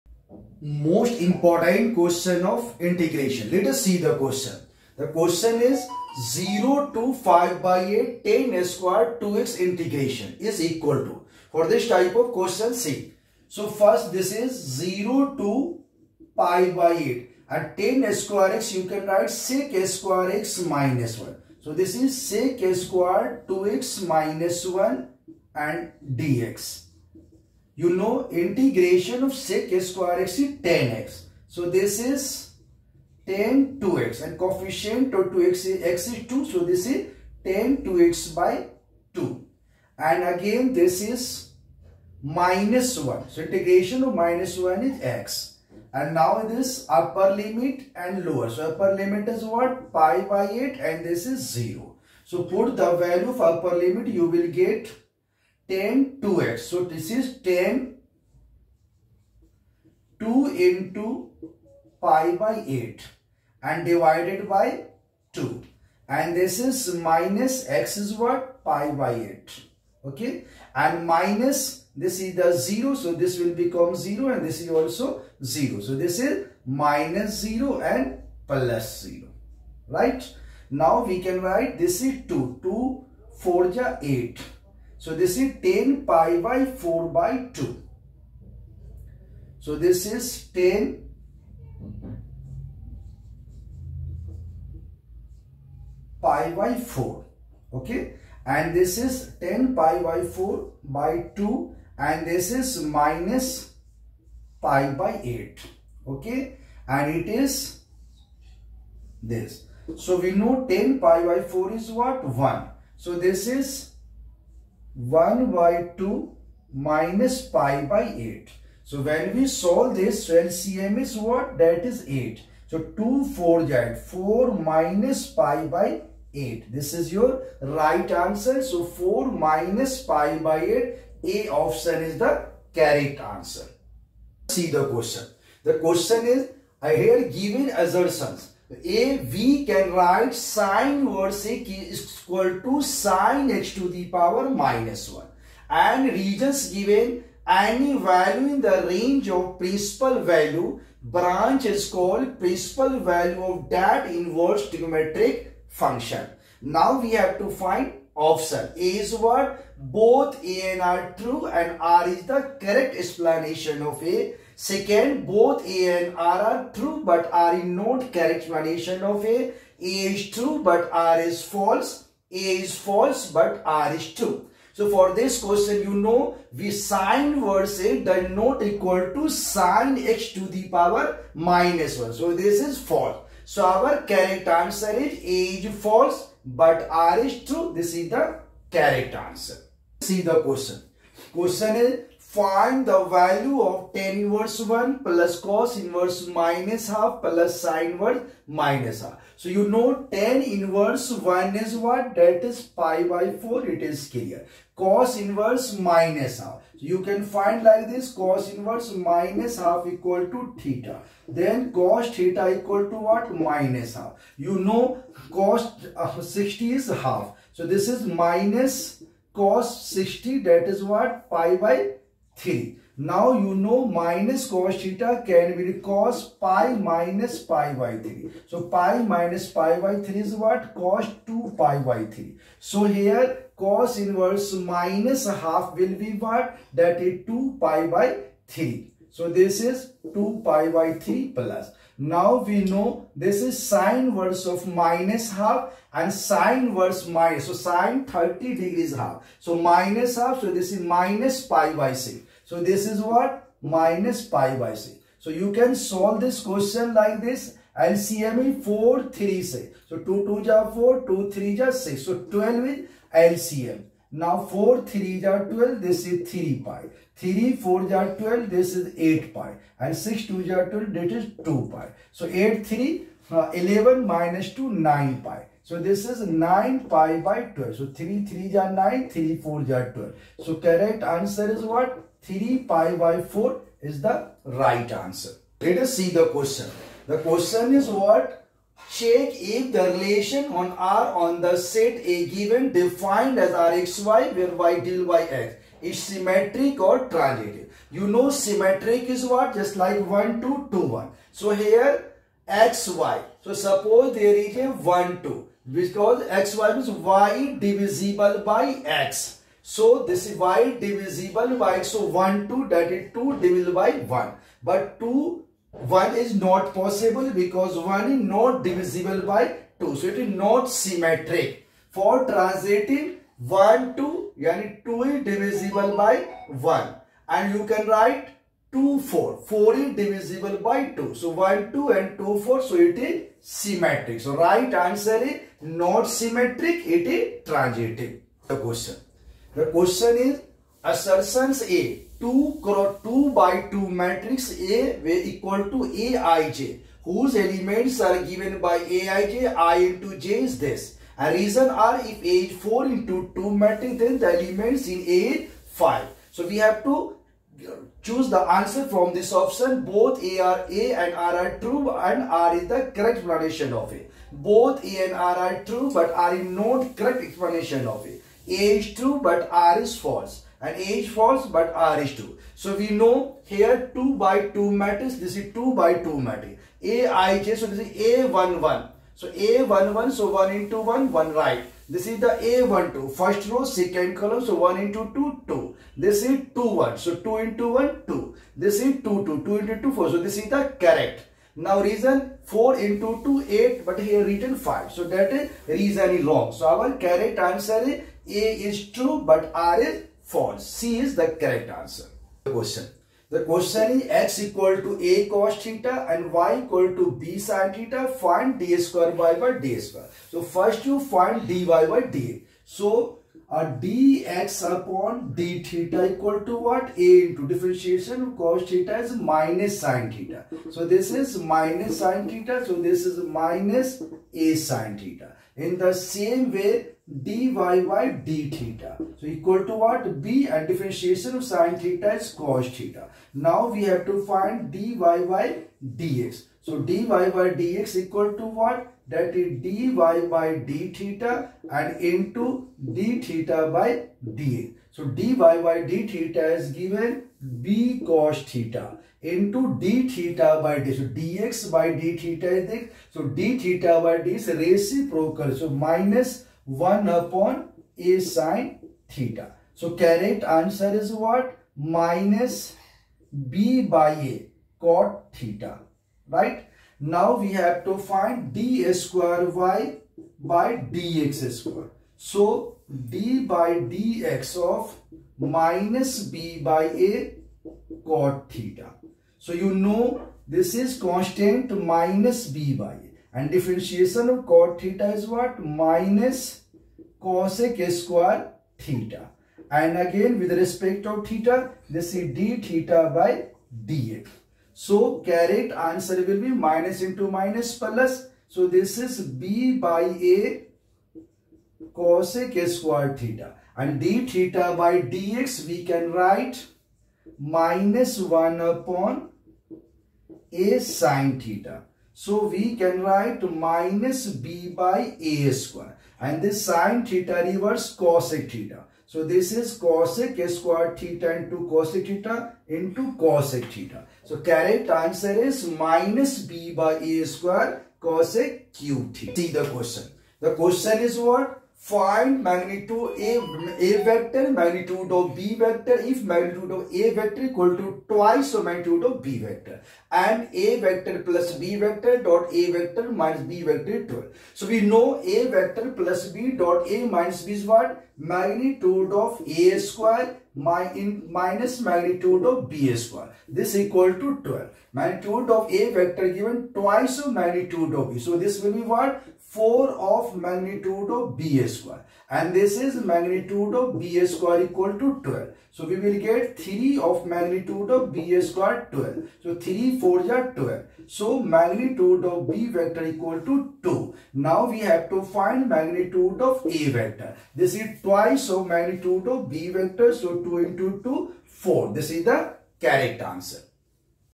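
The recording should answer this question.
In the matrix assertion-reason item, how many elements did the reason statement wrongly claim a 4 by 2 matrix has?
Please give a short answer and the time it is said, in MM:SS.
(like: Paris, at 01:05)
5, at 05:54.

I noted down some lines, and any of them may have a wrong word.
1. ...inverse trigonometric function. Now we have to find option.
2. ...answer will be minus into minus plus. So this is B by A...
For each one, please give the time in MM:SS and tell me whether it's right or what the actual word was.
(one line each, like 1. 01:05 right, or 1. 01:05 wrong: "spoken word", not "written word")
1. 02:34 right
2. 08:15 right.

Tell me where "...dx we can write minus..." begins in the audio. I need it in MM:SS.
08:25.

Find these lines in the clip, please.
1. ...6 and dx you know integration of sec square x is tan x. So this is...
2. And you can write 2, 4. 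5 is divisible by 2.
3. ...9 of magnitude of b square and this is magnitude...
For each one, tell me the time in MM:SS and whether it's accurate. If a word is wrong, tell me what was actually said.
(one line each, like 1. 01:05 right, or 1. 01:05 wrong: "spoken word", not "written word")
1. 00:24 wrong: "1", not "6"
2. 05:27 wrong: "4", not "5"
3. 09:19 wrong: "4", not "9".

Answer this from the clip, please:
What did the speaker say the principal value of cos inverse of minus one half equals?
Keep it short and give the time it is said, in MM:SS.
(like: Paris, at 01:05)
2 pi by 3, at 03:56.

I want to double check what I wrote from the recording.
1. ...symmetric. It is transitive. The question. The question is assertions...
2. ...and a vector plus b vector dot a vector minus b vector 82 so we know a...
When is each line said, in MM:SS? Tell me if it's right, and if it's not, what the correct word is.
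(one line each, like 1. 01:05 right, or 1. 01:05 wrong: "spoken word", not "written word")
1. 05:36 right
2. 09:00 wrong: "12", not "82".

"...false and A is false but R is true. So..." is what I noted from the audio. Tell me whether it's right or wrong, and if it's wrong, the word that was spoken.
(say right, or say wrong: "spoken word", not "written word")
right.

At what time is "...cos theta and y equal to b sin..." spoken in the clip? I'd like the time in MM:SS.
06:45.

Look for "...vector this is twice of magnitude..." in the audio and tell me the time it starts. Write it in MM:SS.
09:36.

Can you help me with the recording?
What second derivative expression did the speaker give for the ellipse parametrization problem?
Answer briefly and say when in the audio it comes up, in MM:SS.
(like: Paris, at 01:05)
minus b by a square cosec cube theta, at 08:45.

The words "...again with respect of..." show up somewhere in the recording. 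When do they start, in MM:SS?
08:10.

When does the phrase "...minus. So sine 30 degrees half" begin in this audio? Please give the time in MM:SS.
04:07.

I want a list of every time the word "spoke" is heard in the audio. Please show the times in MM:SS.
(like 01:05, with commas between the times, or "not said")
not said.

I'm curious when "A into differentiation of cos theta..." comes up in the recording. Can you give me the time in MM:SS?
06:56.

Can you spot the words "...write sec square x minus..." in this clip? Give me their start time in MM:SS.
00:19.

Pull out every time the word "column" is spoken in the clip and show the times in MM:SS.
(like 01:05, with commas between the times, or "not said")
06:24.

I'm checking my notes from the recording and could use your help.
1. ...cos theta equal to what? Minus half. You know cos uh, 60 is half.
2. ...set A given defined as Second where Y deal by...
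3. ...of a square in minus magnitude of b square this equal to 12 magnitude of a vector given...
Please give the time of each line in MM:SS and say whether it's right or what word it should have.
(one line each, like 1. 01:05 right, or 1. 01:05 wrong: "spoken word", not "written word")
1. 03:31 right
2. 04:51 wrong: "Rxy", not "Second"
3. 09:09 right.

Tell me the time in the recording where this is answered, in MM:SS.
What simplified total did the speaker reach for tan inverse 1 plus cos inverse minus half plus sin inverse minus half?
04:42.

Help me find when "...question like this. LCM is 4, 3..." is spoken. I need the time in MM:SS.
04:16.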